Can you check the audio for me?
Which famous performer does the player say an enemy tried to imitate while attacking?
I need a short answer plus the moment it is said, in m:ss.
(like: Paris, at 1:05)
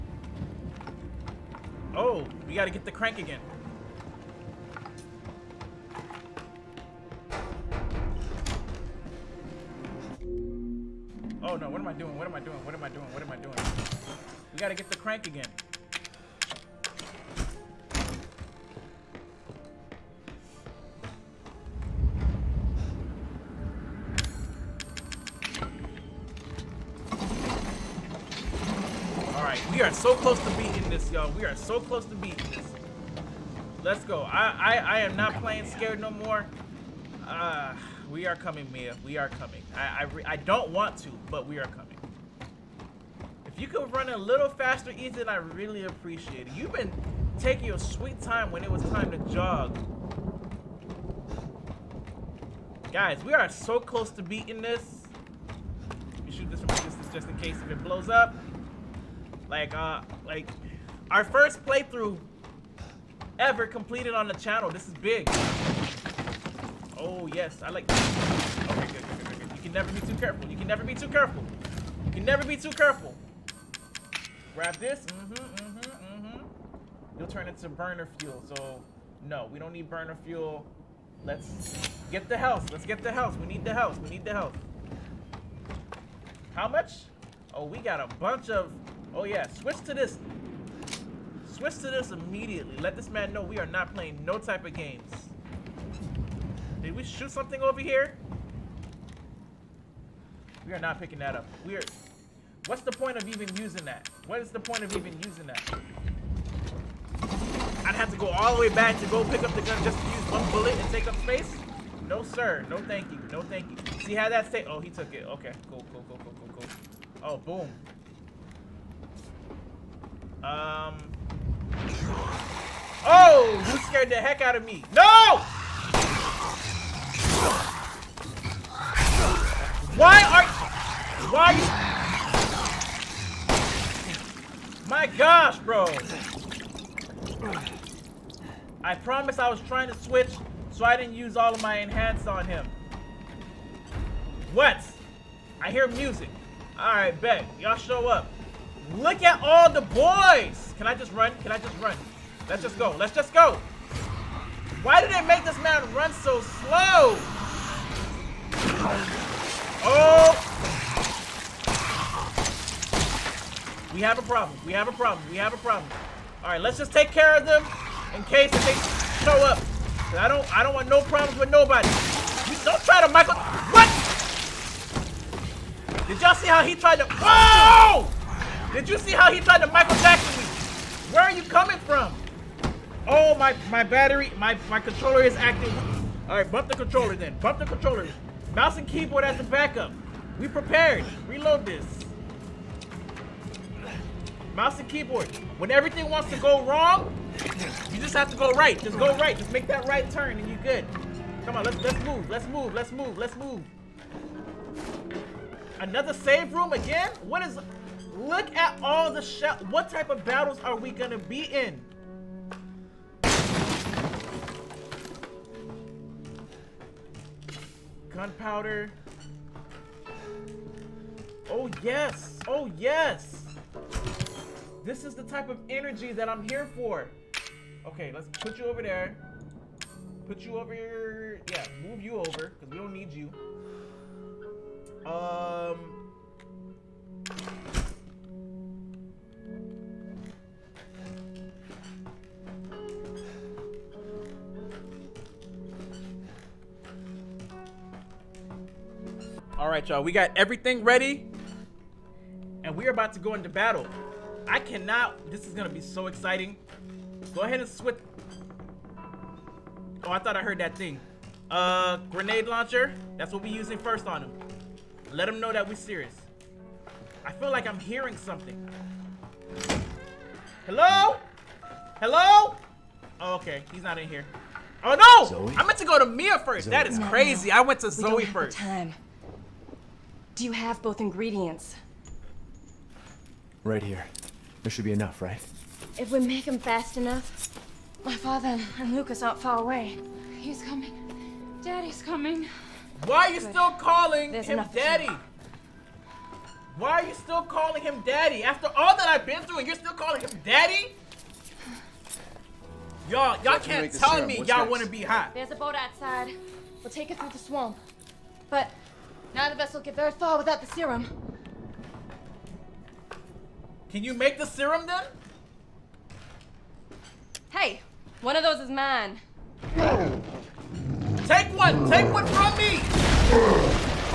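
Michael Jackson, at 2:59.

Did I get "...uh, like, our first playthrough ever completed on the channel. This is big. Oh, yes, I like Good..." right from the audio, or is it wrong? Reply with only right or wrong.
wrong.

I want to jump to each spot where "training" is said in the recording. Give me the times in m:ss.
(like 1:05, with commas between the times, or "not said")
not said.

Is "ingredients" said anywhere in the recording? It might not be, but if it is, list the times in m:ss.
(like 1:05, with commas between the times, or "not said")
4:40.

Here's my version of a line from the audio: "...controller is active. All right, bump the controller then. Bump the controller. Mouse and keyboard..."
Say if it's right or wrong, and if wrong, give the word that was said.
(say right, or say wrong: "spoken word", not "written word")
right.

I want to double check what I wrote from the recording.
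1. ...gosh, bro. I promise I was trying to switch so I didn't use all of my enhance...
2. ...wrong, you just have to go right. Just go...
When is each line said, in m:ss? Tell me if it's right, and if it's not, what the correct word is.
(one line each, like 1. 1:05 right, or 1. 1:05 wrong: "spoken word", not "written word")
1. 2:15 right
2. 3:16 right.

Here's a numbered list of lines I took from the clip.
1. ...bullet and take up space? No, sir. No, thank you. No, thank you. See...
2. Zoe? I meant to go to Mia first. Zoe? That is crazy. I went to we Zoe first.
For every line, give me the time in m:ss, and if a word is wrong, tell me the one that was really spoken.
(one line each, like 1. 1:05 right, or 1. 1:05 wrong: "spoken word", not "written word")
1. 1:50 right
2. 4:35 right.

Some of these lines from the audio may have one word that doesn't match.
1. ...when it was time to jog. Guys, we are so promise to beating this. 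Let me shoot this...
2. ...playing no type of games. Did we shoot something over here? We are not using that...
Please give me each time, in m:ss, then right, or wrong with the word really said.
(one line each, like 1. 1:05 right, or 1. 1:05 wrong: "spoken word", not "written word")
1. 0:48 wrong: "close", not "promise"
2. 1:33 wrong: "picking", not "using".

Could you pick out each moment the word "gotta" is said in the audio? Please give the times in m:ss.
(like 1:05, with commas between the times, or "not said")
0:02, 0:14.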